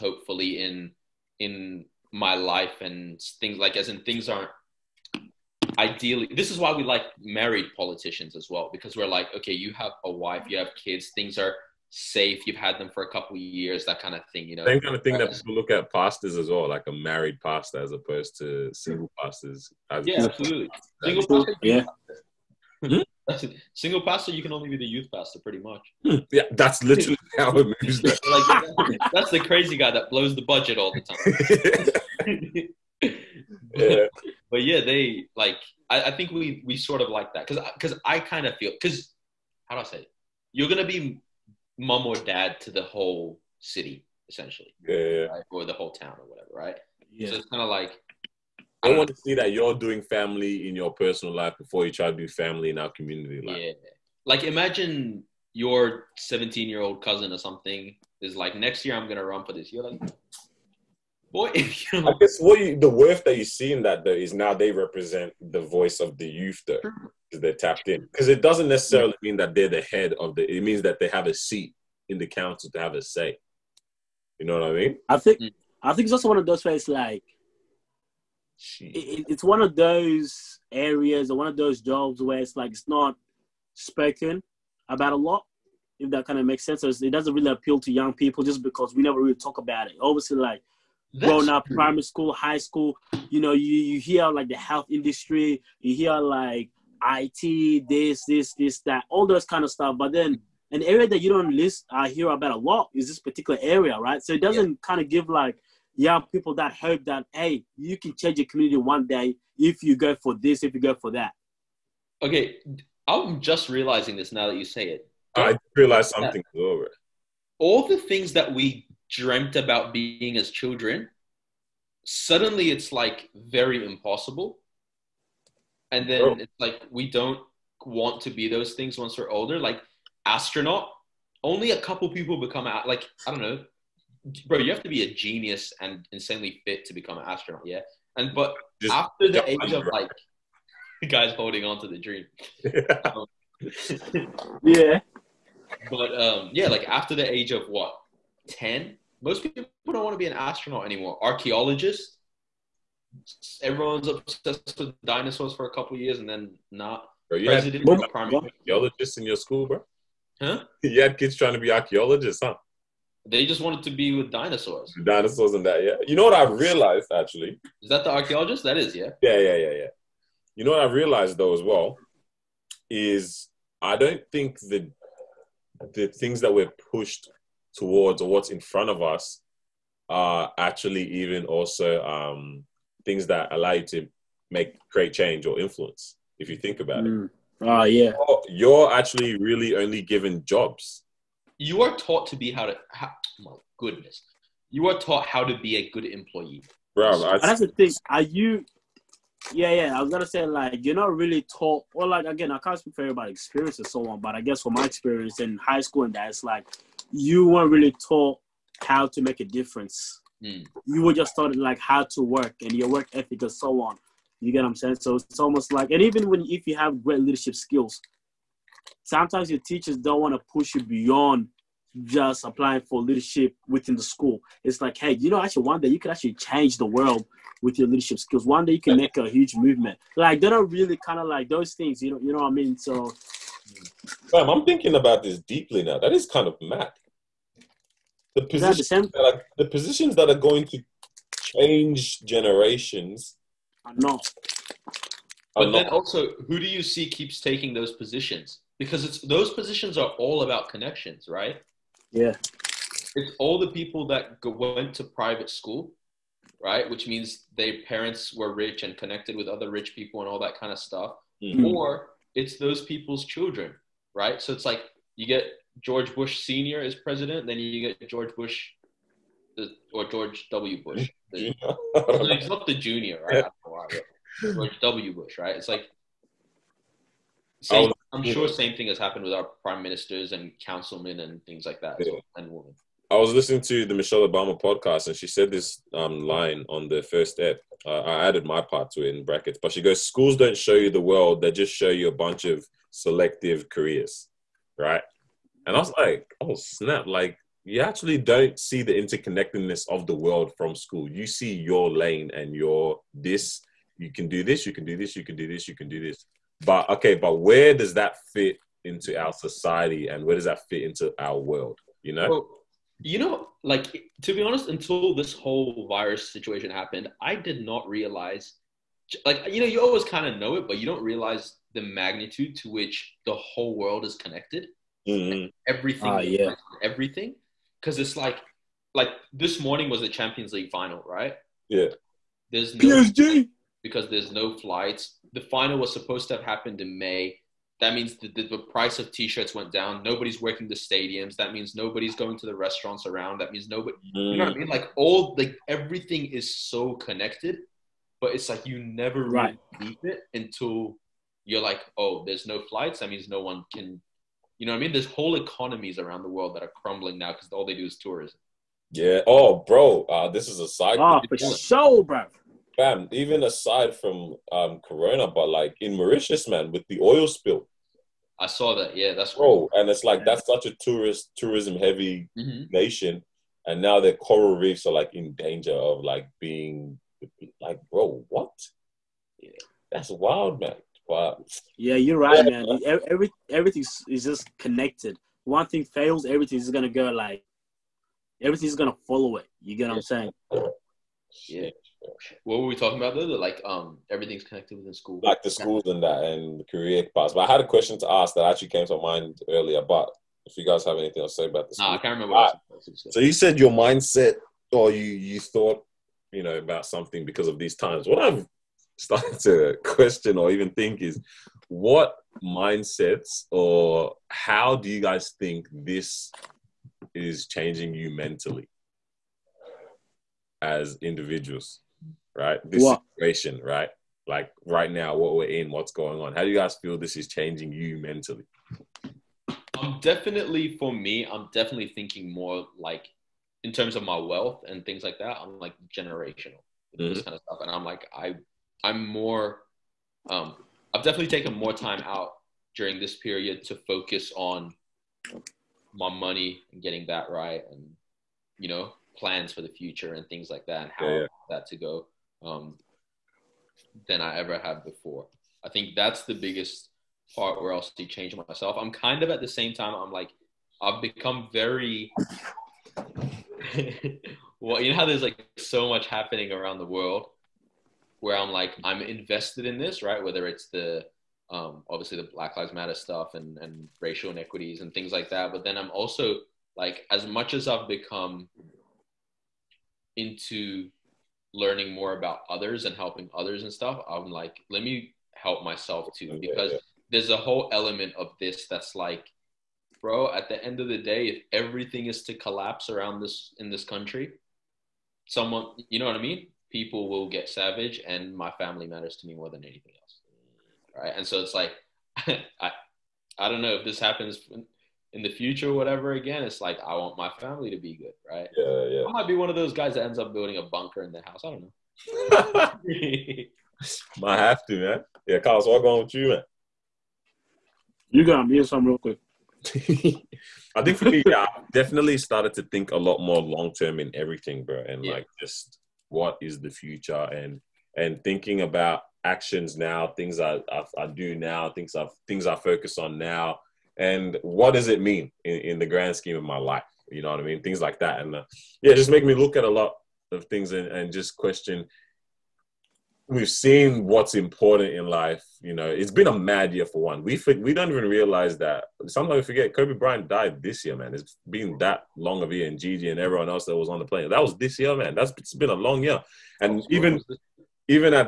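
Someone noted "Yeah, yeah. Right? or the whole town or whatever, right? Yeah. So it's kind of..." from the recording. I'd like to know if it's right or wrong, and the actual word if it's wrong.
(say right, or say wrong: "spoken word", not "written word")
right.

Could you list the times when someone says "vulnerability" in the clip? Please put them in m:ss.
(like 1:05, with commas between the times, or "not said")
not said.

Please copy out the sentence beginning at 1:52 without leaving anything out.
Okay, I'm just realizing this now that you say it.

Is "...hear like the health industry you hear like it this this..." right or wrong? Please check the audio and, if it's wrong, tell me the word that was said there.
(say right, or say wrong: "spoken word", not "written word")
right.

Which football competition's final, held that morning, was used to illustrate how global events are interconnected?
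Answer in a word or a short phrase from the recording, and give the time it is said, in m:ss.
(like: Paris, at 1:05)
Champions League, at 5:30.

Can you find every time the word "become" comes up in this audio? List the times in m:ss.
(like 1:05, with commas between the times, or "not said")
2:12, 2:16, 7:41, 7:57.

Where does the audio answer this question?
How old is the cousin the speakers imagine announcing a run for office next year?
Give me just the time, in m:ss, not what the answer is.
0:56.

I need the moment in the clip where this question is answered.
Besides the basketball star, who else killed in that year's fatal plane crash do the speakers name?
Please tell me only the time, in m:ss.
9:12.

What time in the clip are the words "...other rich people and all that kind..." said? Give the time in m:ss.
4:19.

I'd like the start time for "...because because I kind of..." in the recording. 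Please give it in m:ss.
0:37.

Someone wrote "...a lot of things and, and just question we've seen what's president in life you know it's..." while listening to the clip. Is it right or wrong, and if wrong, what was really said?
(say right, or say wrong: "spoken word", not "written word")
wrong: "important", not "president".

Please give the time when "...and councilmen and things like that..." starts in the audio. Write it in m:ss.
4:40.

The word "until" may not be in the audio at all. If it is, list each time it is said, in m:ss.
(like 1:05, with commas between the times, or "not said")
5:14, 5:50.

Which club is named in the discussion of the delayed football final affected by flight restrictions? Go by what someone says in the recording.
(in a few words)
PSG.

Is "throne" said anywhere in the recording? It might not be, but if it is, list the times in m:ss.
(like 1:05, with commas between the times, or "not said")
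not said.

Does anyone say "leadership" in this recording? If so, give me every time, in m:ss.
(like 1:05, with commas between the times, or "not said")
3:37, 3:43, 3:47.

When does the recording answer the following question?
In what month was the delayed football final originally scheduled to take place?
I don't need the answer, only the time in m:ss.
5:36.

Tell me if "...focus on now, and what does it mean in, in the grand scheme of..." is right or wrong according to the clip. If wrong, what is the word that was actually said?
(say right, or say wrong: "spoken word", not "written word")
right.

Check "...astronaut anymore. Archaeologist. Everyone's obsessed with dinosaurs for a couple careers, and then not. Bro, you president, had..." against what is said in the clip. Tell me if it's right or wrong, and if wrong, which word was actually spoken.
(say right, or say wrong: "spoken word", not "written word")
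wrong: "years", not "careers".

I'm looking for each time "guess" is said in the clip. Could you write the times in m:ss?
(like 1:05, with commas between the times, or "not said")
1:02, 3:24.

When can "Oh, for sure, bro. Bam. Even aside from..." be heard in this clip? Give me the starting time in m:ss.
6:00.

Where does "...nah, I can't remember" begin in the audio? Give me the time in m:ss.
6:41.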